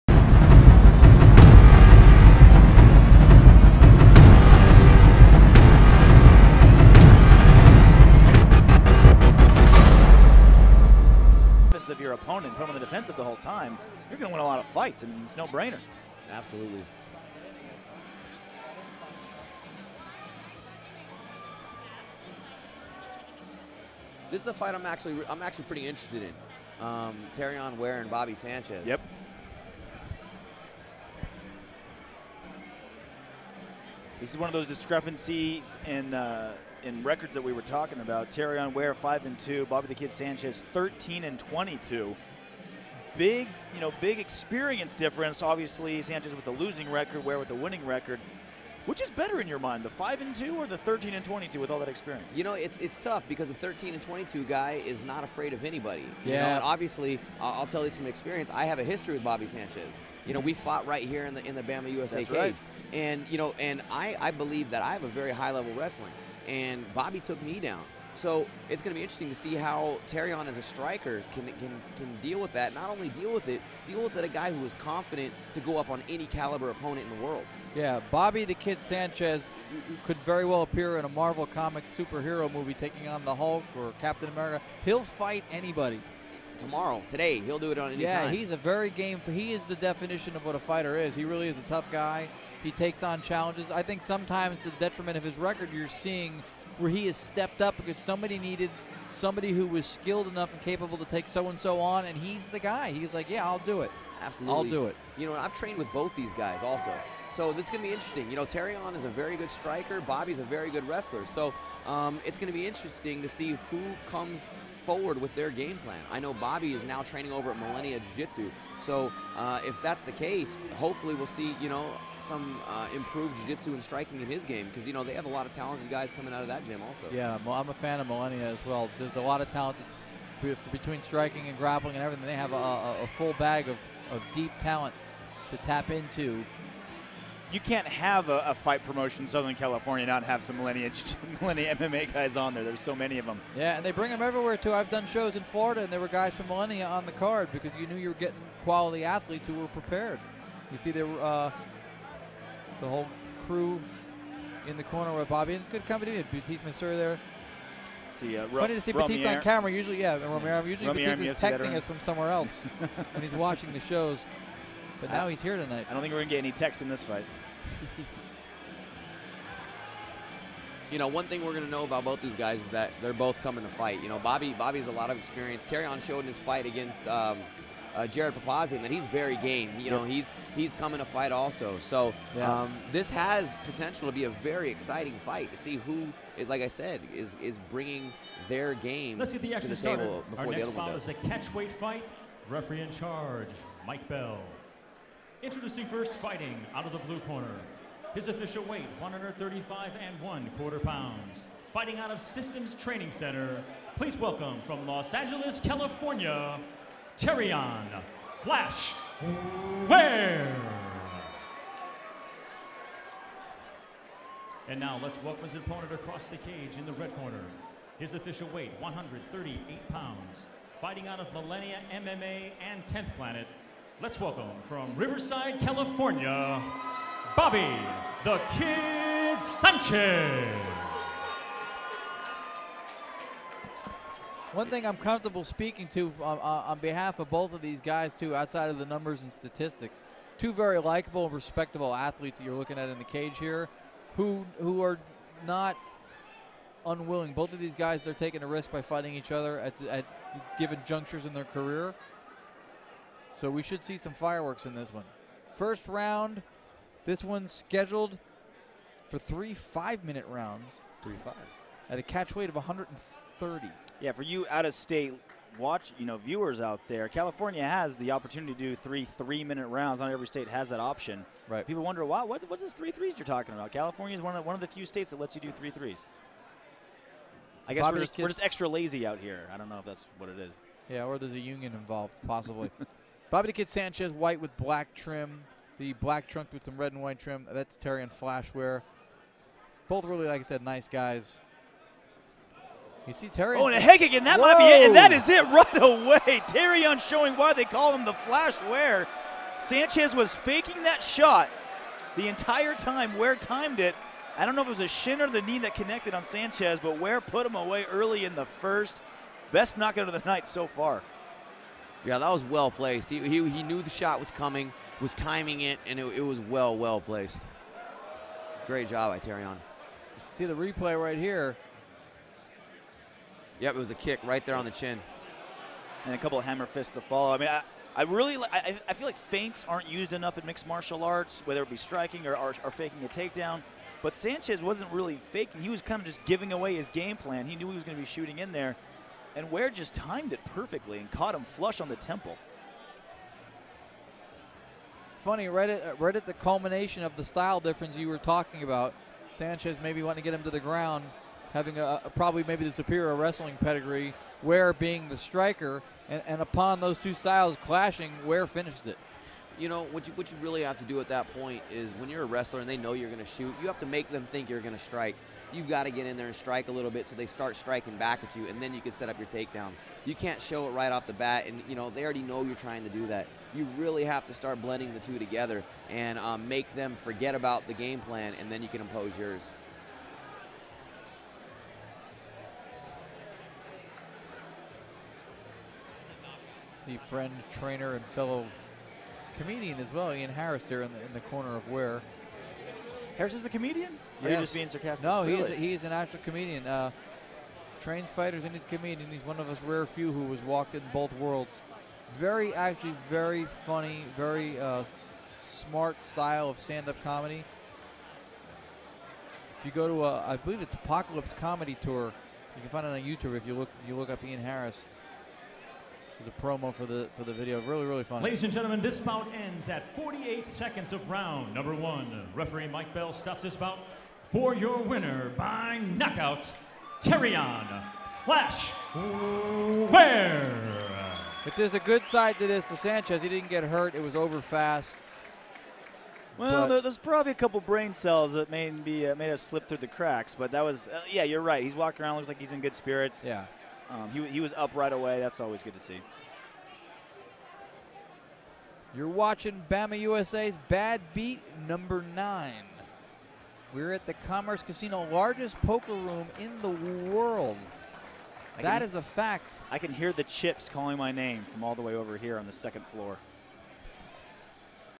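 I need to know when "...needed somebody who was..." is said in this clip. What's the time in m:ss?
1:38.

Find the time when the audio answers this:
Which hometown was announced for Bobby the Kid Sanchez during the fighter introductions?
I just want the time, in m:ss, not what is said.
3:44.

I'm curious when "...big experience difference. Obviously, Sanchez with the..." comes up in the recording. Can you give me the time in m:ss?
0:44.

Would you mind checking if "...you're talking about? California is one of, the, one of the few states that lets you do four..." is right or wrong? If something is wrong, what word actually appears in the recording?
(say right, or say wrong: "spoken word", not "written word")
wrong: "three", not "four".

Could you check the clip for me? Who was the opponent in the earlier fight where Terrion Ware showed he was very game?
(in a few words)
Jared Papazian.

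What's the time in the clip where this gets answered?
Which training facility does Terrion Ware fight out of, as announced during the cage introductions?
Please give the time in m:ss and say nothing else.
3:22.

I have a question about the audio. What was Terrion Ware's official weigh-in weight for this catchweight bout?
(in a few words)
135 and 1/4 pounds.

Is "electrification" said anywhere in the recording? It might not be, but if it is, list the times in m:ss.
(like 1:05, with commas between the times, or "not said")
not said.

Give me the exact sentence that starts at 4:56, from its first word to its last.
Terrion showing why they call him the Flash Ware.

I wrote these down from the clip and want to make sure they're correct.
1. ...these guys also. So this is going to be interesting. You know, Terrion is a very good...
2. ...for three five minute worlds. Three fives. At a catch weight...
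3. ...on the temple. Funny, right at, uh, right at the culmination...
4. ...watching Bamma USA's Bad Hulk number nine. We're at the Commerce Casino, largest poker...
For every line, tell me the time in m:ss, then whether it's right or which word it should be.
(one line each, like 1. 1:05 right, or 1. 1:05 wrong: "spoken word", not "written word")
1. 1:46 right
2. 4:19 wrong: "rounds", not "worlds"
3. 5:41 right
4. 7:29 wrong: "Beat", not "Hulk".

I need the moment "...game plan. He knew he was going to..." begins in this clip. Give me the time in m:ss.
5:36.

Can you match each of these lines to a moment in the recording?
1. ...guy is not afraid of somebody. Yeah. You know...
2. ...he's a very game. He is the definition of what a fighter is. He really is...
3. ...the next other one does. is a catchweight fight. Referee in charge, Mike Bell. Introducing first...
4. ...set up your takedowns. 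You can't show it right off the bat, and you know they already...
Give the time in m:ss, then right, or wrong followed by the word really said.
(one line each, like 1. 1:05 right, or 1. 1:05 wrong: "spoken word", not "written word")
1. 0:54 wrong: "anybody", not "somebody"
2. 1:28 right
3. 3:10 right
4. 6:08 right.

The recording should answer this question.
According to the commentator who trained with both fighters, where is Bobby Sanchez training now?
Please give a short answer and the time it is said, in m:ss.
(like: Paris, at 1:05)
Millennia Jiu-Jitsu, at 1:57.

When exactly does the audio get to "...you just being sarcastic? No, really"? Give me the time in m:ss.
6:34.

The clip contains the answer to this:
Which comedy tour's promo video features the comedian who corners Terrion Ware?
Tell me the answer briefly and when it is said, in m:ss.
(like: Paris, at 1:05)
Apocalypse Comedy Tour, at 6:50.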